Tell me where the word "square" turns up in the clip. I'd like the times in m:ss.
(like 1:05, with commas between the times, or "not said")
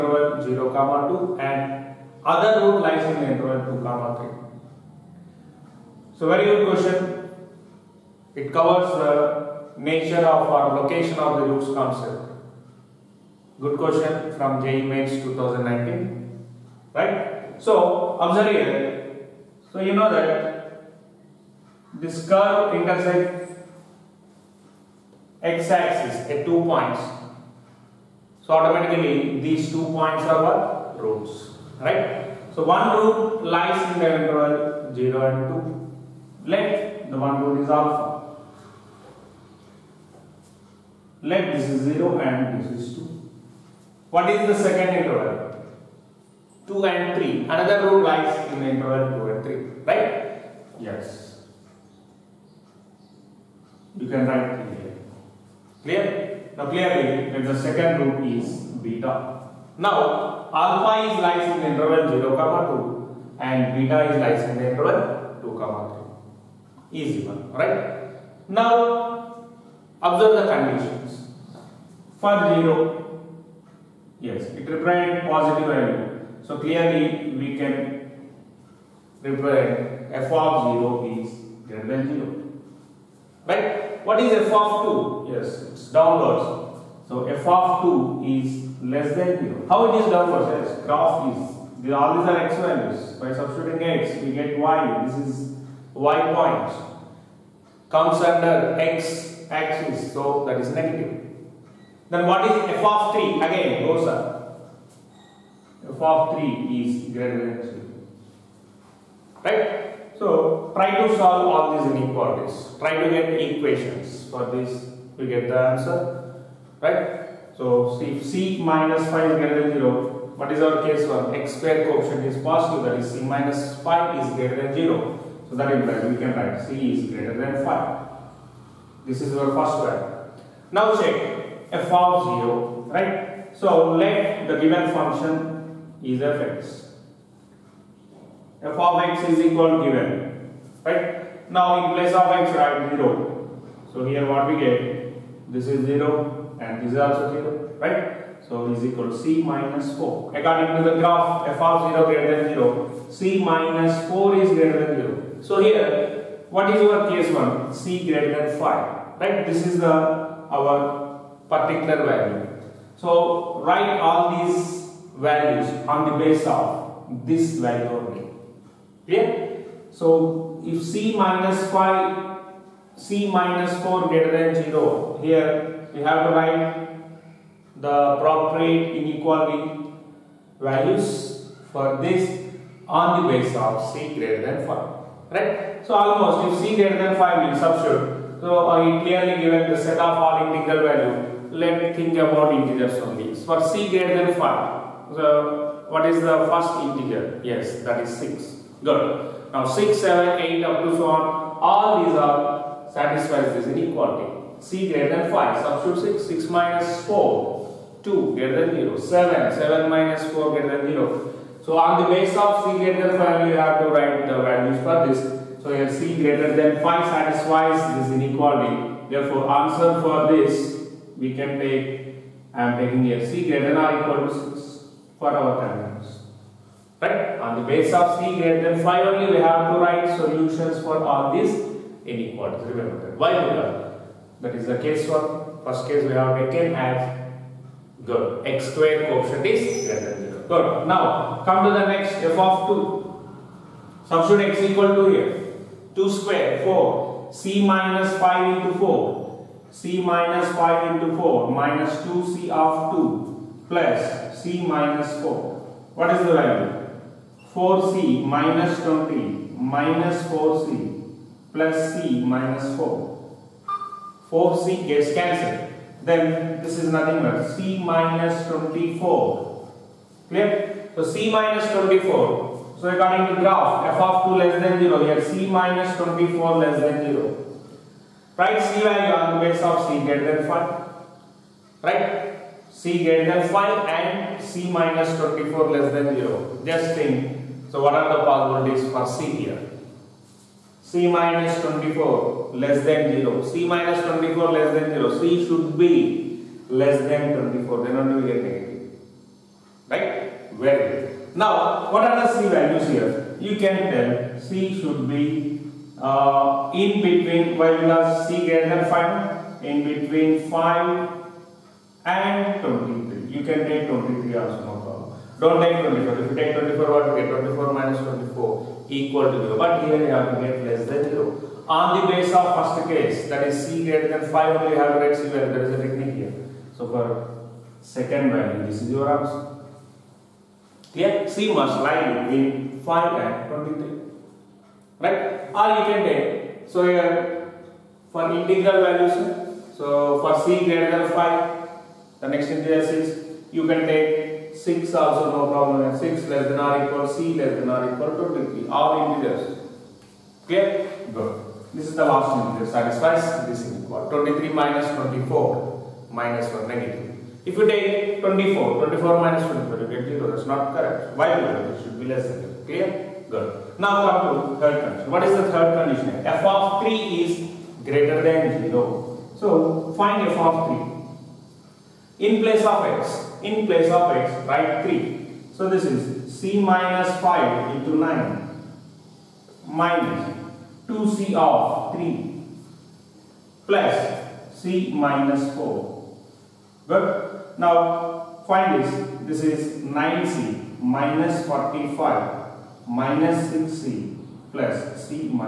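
2:01, 3:58, 4:06.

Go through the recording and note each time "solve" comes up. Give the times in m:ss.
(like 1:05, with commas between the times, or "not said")
1:51.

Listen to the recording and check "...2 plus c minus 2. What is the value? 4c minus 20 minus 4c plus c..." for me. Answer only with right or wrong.
wrong.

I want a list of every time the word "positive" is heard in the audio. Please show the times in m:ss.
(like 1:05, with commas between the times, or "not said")
1:15, 2:02.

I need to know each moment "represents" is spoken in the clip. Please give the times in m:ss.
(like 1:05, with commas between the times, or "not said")
1:14, 1:19.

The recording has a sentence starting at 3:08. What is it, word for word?
So uh, clearly given the set of all integral value.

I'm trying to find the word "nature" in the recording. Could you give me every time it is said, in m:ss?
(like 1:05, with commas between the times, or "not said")
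0:09.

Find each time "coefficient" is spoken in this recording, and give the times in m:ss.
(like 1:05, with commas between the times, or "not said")
2:01, 3:59.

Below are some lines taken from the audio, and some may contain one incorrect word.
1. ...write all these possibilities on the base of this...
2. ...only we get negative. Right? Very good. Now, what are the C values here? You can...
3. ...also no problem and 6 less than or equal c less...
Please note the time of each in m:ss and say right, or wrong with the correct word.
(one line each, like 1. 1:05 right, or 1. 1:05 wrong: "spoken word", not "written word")
1. 2:43 wrong: "values", not "possibilities"
2. 4:57 right
3. 5:44 right.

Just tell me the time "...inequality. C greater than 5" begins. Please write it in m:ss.
3:23.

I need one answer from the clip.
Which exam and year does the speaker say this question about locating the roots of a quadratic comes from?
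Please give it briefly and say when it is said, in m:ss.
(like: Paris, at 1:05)
JEE Mains 2019, at 0:14.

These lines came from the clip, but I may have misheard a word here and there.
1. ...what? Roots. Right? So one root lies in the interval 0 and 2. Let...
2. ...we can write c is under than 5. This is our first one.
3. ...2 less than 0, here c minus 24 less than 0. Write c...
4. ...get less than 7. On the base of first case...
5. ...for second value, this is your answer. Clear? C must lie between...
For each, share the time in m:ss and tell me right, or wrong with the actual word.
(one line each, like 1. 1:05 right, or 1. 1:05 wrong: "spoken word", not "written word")
1. 0:30 right
2. 2:06 wrong: "greater", not "under"
3. 4:34 right
4. 5:20 wrong: "0", not "7"
5. 5:26 right.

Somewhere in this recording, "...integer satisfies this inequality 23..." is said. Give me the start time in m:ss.
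5:52.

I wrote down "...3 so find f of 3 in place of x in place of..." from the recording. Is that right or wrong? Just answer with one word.
wrong.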